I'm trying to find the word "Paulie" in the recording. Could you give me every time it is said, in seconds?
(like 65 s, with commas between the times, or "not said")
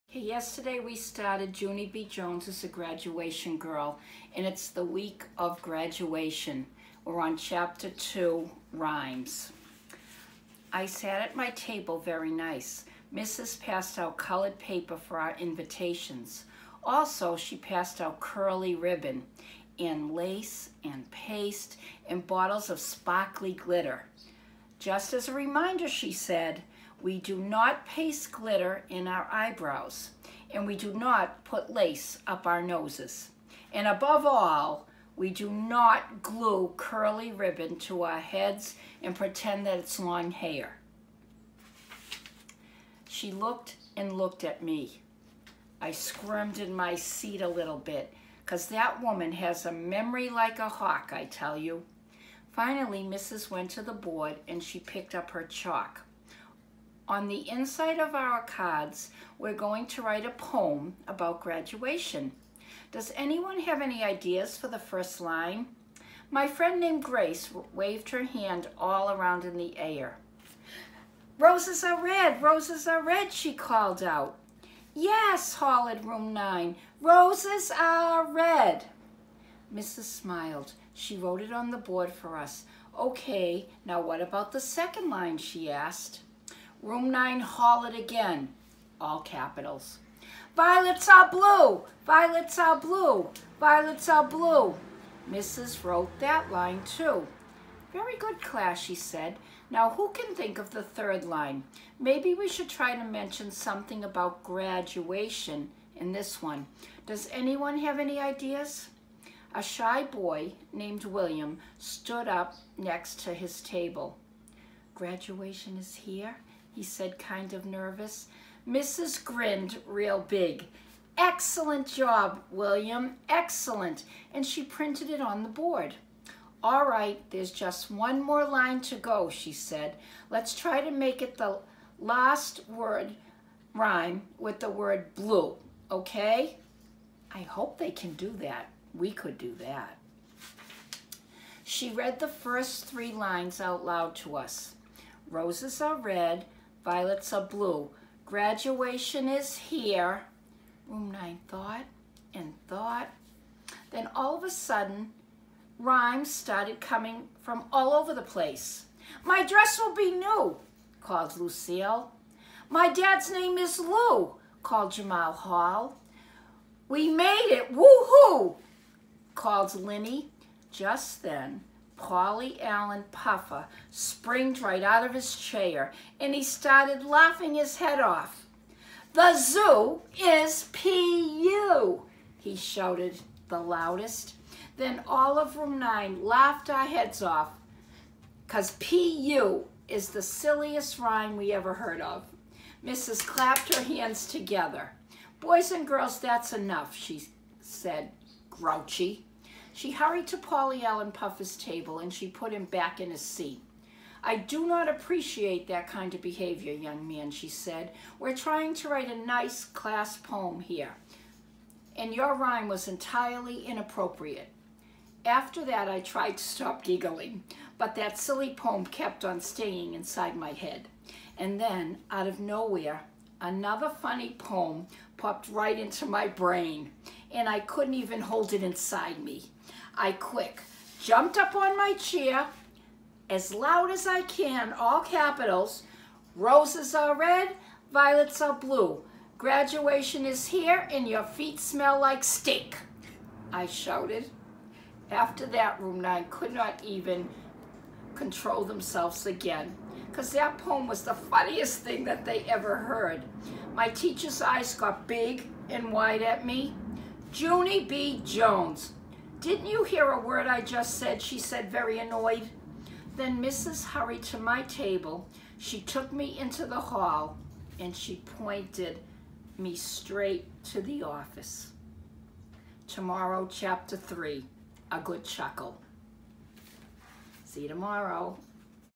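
172 s, 200 s.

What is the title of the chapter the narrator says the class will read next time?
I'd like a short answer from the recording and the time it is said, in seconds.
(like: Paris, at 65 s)
A Good Chuckle, at 274 s.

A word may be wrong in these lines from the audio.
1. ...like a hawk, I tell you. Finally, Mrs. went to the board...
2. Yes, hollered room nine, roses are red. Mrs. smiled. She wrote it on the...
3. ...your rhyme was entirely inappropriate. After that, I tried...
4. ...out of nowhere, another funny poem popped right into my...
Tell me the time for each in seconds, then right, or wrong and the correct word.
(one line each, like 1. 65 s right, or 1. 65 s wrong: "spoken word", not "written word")
1. 50 s right
2. 74 s right
3. 212 s right
4. 222 s right.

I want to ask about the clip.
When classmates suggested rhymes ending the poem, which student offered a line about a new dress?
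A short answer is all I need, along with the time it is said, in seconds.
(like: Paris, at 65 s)
Lucille, at 161 s.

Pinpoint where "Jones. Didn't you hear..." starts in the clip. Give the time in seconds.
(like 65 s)
258 s.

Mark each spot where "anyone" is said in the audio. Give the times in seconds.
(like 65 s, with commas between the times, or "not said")
63 s, 107 s.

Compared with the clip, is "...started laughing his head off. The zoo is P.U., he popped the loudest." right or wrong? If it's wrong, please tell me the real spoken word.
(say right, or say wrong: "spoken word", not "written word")
wrong: "shouted", not "popped".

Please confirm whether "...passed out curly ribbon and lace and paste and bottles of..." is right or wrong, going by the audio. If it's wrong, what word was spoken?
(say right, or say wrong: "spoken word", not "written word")
right.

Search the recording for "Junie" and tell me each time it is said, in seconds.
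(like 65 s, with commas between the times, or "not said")
1 s, 257 s.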